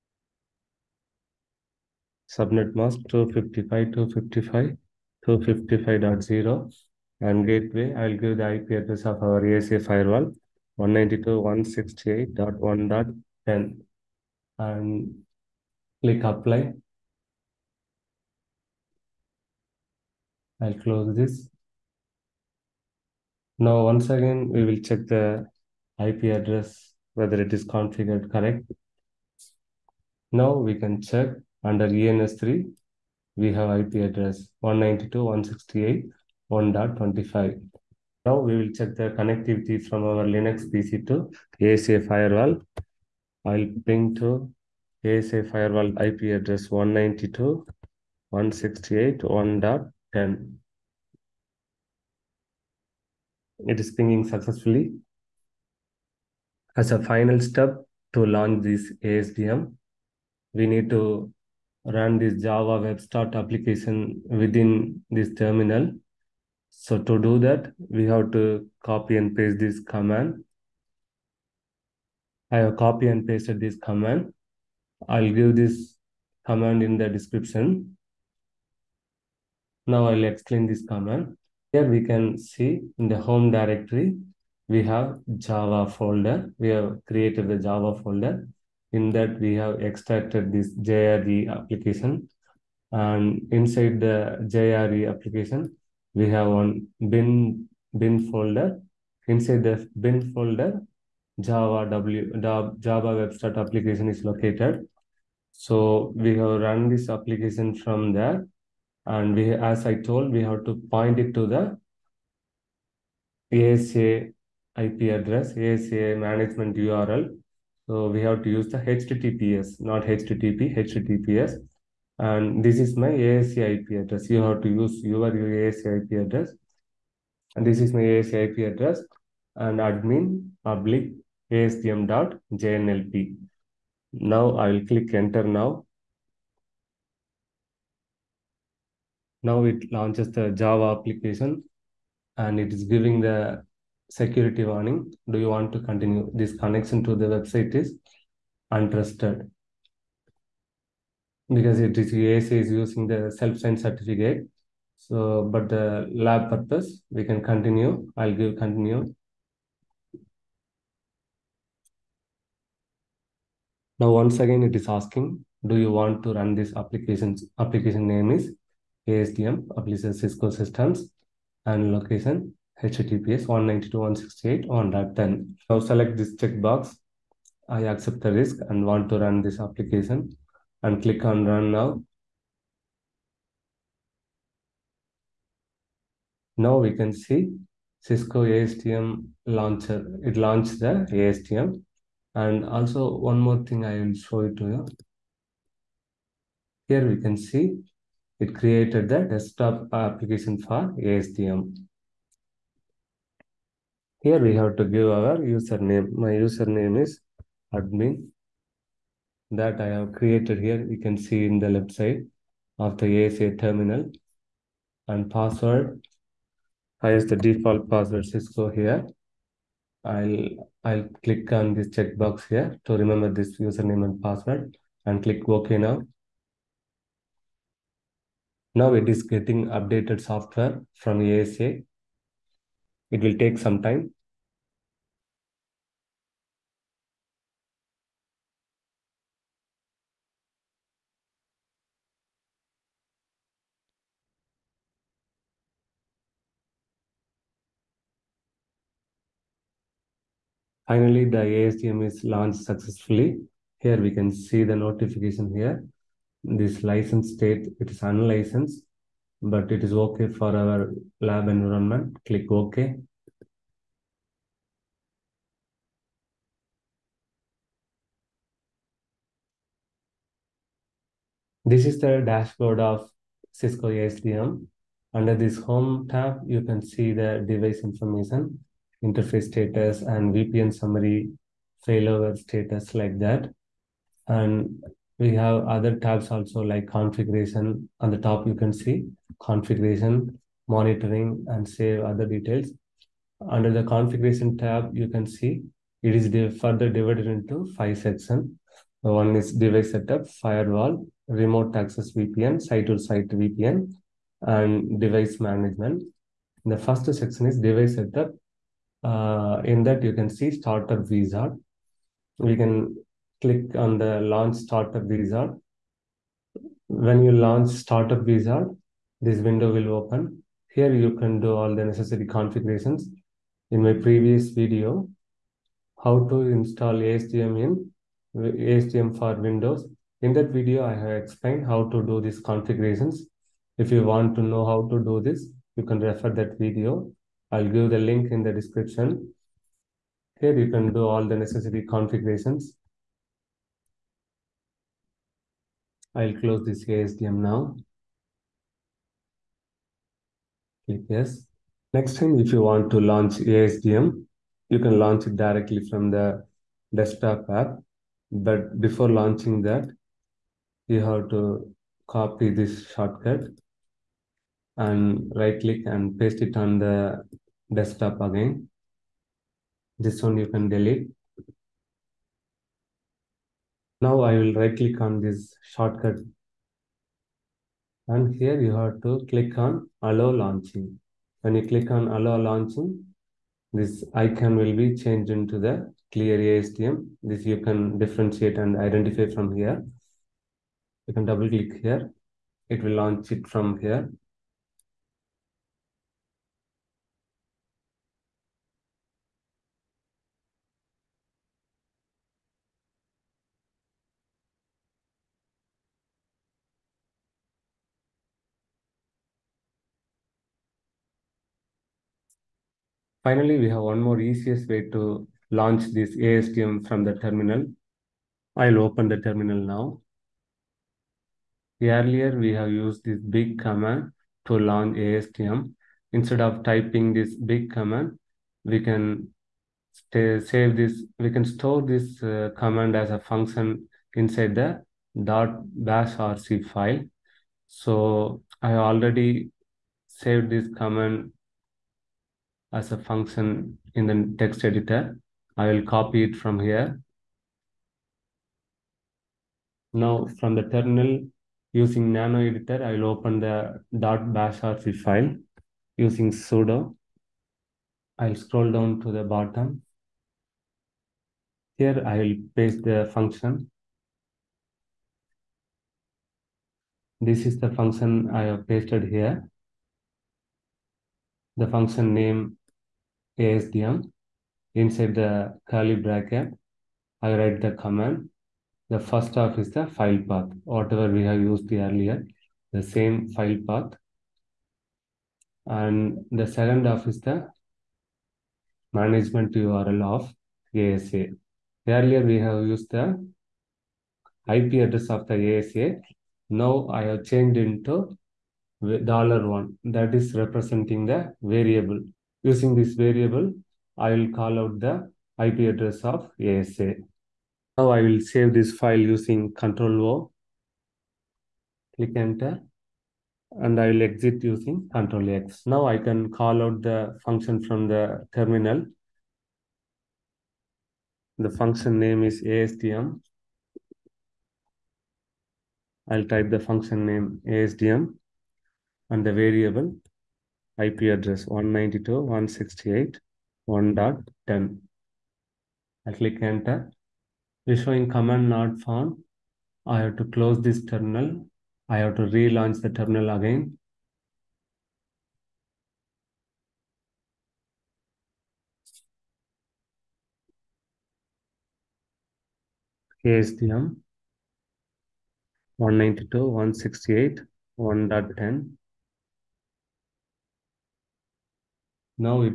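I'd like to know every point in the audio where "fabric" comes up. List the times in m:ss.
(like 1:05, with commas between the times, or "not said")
not said.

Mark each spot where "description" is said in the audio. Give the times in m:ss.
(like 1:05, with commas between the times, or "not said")
1:17, 5:38.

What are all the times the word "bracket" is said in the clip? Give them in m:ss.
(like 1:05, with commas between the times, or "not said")
7:55.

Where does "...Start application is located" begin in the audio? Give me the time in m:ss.
1:43.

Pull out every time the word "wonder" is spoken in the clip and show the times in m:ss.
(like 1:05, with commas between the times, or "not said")
not said.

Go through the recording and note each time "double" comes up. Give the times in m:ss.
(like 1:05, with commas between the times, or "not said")
6:31.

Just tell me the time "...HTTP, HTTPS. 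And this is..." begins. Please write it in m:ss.
2:00.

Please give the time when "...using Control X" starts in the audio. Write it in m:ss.
8:34.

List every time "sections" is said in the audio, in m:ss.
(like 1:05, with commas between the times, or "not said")
4:57, 5:07.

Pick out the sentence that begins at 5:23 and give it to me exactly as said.
In my previous video, how to install ASDM in ASDM for Windows.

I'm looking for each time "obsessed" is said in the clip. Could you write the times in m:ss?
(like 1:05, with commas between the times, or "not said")
not said.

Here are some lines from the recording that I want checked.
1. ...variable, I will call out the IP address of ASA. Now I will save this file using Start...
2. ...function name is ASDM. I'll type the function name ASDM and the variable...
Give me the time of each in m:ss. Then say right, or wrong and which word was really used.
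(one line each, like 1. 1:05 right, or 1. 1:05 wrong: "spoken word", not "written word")
1. 8:22 wrong: "Control", not "Start"
2. 8:41 right.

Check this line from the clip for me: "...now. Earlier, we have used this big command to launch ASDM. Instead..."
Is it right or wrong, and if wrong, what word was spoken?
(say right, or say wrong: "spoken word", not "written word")
right.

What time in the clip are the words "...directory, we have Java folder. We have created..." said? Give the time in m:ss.
1:23.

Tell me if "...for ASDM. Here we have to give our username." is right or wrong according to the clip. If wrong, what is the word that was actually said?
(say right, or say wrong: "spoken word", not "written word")
right.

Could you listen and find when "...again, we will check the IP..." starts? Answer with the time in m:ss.
0:24.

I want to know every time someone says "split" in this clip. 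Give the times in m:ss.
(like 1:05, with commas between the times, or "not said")
not said.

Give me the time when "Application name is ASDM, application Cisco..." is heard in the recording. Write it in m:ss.
2:47.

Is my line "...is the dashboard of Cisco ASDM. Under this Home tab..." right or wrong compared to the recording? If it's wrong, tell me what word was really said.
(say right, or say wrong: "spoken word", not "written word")
right.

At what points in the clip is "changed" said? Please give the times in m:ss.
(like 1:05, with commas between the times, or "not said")
6:24, 8:17.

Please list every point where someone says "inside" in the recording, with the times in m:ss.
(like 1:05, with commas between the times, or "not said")
1:33, 1:39, 7:14, 7:54.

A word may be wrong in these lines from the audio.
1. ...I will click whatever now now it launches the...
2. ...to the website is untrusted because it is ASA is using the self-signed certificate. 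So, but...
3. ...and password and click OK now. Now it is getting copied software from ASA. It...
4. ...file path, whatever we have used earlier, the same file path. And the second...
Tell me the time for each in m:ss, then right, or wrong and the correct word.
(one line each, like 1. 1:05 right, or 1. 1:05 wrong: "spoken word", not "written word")
1. 2:14 wrong: "enter", not "whatever"
2. 2:27 right
3. 3:44 wrong: "updated", not "copied"
4. 7:59 right.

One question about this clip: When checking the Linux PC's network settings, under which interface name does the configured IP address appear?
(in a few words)
ENS3.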